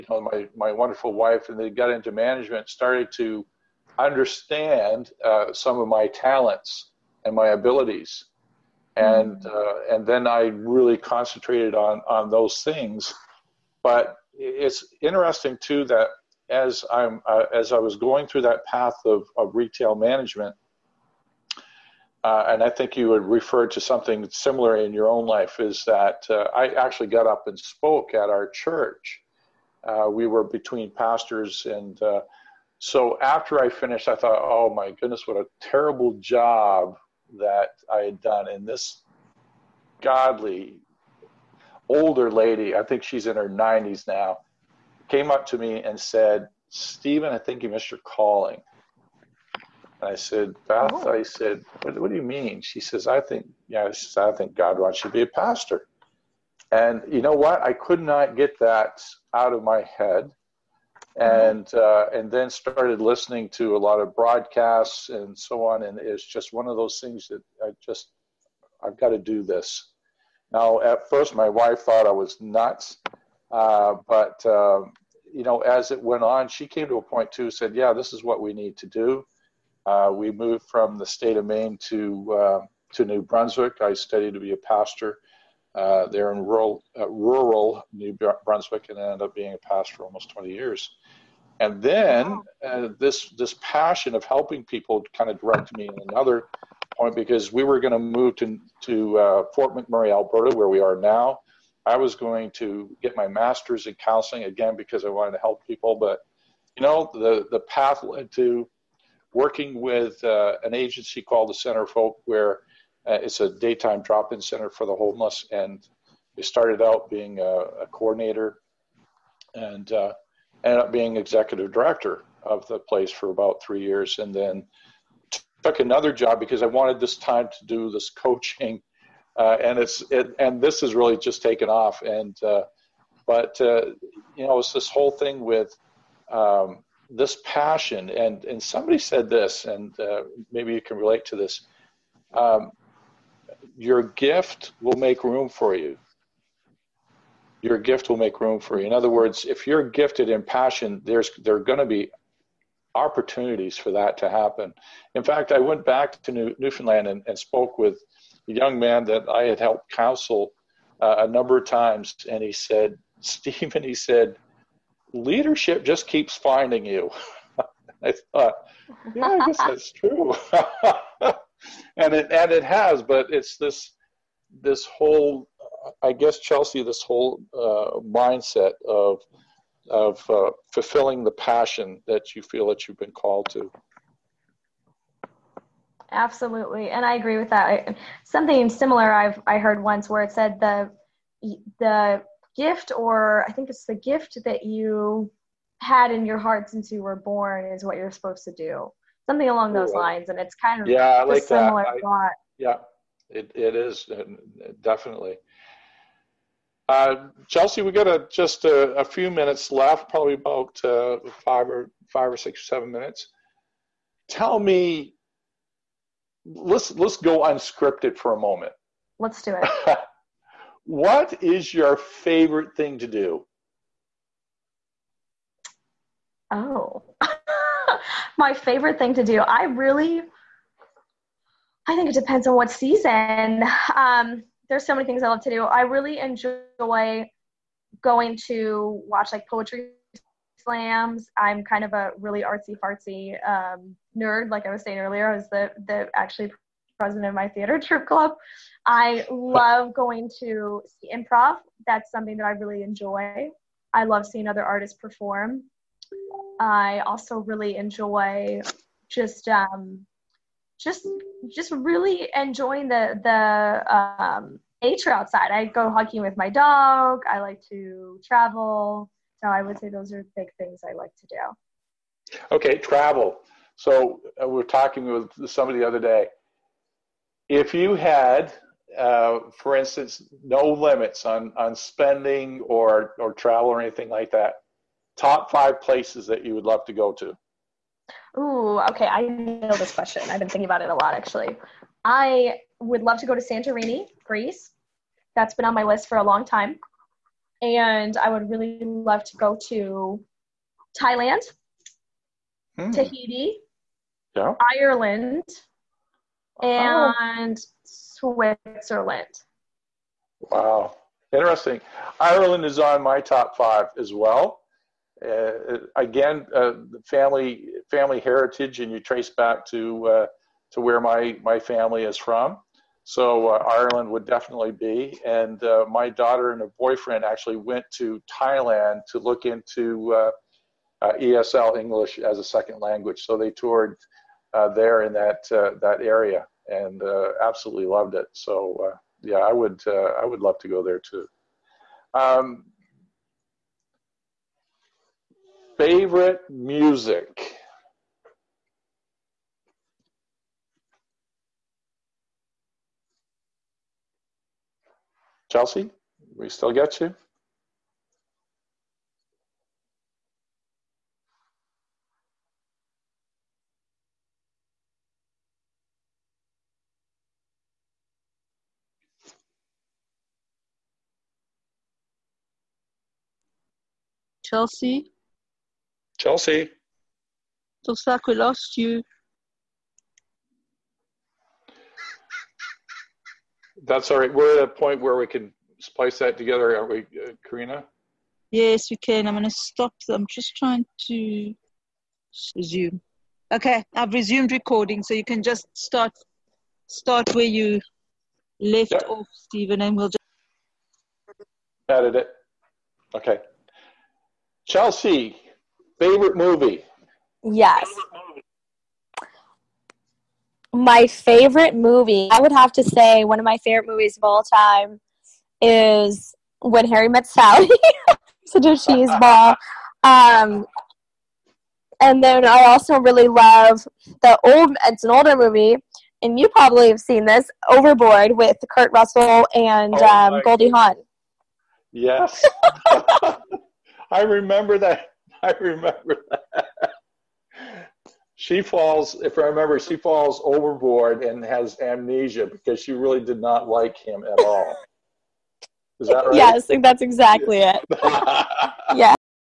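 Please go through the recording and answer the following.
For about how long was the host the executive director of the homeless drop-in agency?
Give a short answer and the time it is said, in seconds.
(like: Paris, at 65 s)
3 years, at 123 s.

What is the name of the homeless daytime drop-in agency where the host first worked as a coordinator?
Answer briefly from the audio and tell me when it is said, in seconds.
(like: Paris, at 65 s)
Center for Hope, at 111 s.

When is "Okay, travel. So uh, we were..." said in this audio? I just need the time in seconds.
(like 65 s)
272 s.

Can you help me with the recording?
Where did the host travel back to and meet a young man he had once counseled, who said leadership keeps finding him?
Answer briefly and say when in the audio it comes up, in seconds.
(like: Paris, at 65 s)
Newfoundland, at 156 s.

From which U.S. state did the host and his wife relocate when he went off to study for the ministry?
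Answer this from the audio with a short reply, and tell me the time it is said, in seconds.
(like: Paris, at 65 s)
Maine, at 81 s.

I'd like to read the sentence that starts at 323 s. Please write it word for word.
So uh, Ireland would definitely be.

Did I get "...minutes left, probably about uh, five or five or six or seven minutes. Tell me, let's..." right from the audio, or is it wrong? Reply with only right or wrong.
right.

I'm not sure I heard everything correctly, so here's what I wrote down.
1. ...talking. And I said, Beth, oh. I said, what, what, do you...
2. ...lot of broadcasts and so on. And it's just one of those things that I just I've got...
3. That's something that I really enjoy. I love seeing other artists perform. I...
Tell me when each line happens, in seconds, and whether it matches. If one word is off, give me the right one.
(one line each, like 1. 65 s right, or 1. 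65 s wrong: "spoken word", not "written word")
1. 48 s wrong: "calling", not "talking"
2. 63 s right
3. 251 s right.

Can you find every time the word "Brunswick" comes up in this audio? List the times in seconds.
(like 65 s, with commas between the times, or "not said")
83 s, 88 s.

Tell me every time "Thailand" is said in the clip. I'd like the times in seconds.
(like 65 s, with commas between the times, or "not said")
300 s, 328 s.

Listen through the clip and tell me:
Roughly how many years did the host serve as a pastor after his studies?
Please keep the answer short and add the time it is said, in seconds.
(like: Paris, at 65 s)
20, at 90 s.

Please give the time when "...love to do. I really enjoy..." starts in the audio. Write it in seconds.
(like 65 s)
235 s.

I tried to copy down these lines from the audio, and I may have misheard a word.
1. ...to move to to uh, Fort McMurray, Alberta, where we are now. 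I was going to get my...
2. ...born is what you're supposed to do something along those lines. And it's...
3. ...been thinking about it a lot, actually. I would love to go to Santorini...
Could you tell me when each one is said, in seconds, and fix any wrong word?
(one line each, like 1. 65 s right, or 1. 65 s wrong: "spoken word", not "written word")
1. 97 s right
2. 197 s right
3. 290 s right.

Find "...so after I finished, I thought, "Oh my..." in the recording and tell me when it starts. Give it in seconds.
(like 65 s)
32 s.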